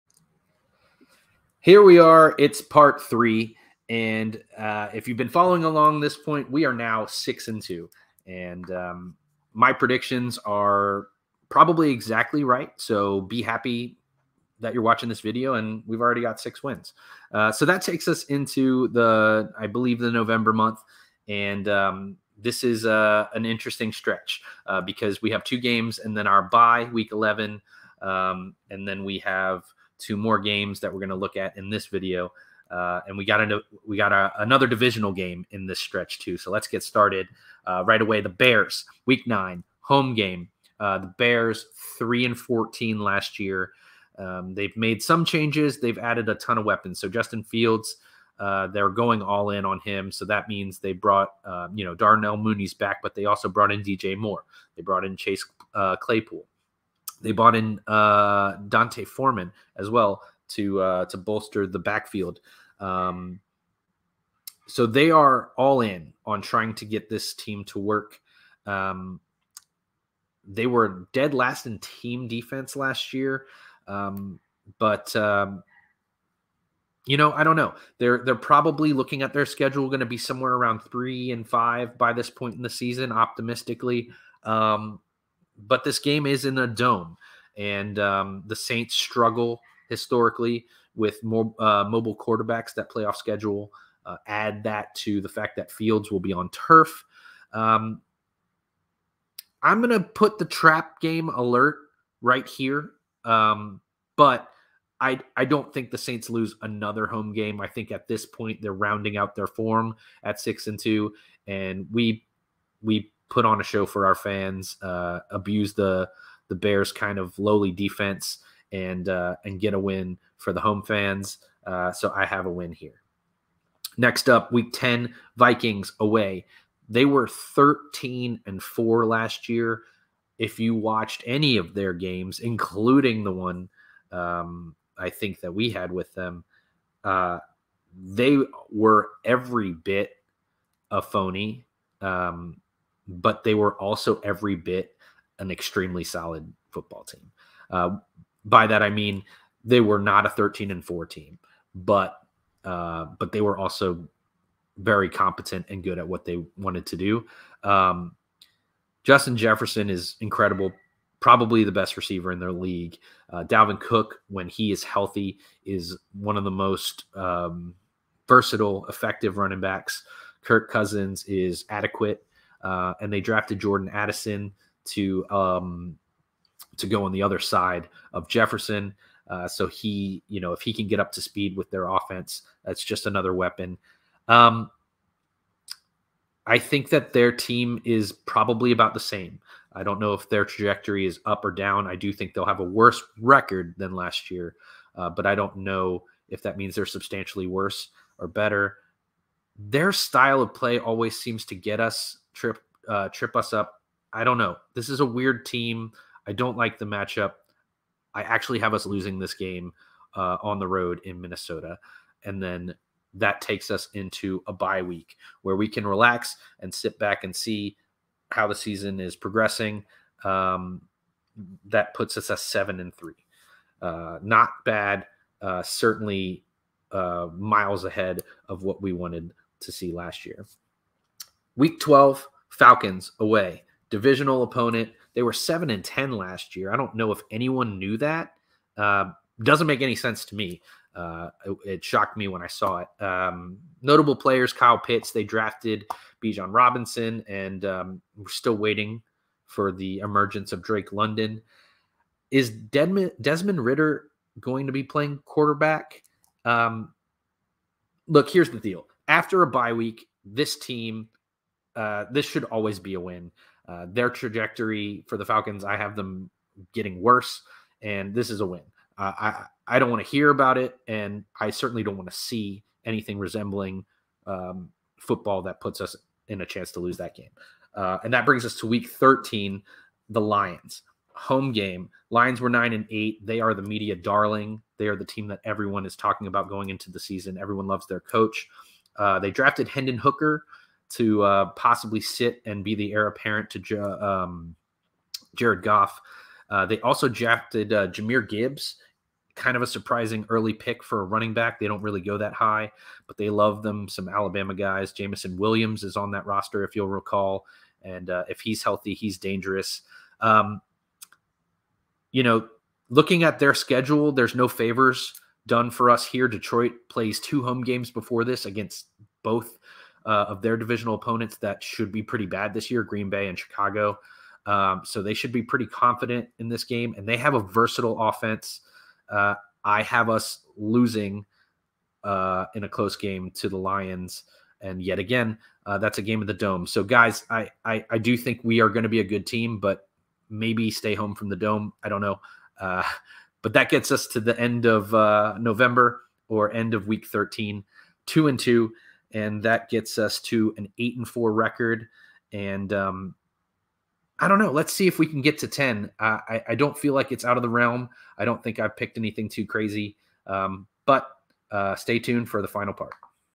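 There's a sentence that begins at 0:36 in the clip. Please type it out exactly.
So let's get started uh, right away.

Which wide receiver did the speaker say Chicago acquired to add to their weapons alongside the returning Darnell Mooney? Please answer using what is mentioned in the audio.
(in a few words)
DJ Moore.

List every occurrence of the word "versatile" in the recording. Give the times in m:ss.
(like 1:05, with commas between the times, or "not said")
2:48, 5:27.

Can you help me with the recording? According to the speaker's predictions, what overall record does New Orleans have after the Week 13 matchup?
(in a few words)
8 and 4.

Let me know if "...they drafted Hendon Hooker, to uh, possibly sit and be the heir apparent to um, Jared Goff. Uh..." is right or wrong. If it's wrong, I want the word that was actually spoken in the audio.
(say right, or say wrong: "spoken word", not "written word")
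right.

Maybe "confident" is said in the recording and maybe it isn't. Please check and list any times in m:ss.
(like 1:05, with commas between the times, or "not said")
5:25.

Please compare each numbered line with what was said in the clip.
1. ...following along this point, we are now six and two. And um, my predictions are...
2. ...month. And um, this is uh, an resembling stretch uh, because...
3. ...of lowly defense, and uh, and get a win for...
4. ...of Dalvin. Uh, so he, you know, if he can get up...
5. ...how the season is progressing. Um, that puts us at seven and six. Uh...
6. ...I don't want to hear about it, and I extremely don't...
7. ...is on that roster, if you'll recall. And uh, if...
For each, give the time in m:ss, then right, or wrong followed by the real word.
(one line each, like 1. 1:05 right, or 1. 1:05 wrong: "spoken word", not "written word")
1. 0:05 right
2. 0:20 wrong: "interesting", not "resembling"
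3. 1:57 right
4. 2:58 wrong: "Jefferson", not "Dalvin"
5. 3:38 wrong: "three", not "six"
6. 4:29 wrong: "certainly", not "extremely"
7. 5:05 right.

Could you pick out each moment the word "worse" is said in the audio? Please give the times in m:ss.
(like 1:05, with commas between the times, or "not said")
3:12, 3:17, 4:27.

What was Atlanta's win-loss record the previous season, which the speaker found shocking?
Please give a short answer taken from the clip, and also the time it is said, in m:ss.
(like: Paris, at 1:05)
7 and 10, at 3:55.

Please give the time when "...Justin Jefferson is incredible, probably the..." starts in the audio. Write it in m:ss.
2:39.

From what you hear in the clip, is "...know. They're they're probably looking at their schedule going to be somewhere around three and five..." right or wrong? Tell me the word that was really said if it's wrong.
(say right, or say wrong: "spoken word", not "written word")
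right.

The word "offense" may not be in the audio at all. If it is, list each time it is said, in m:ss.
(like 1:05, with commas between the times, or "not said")
3:01, 5:28.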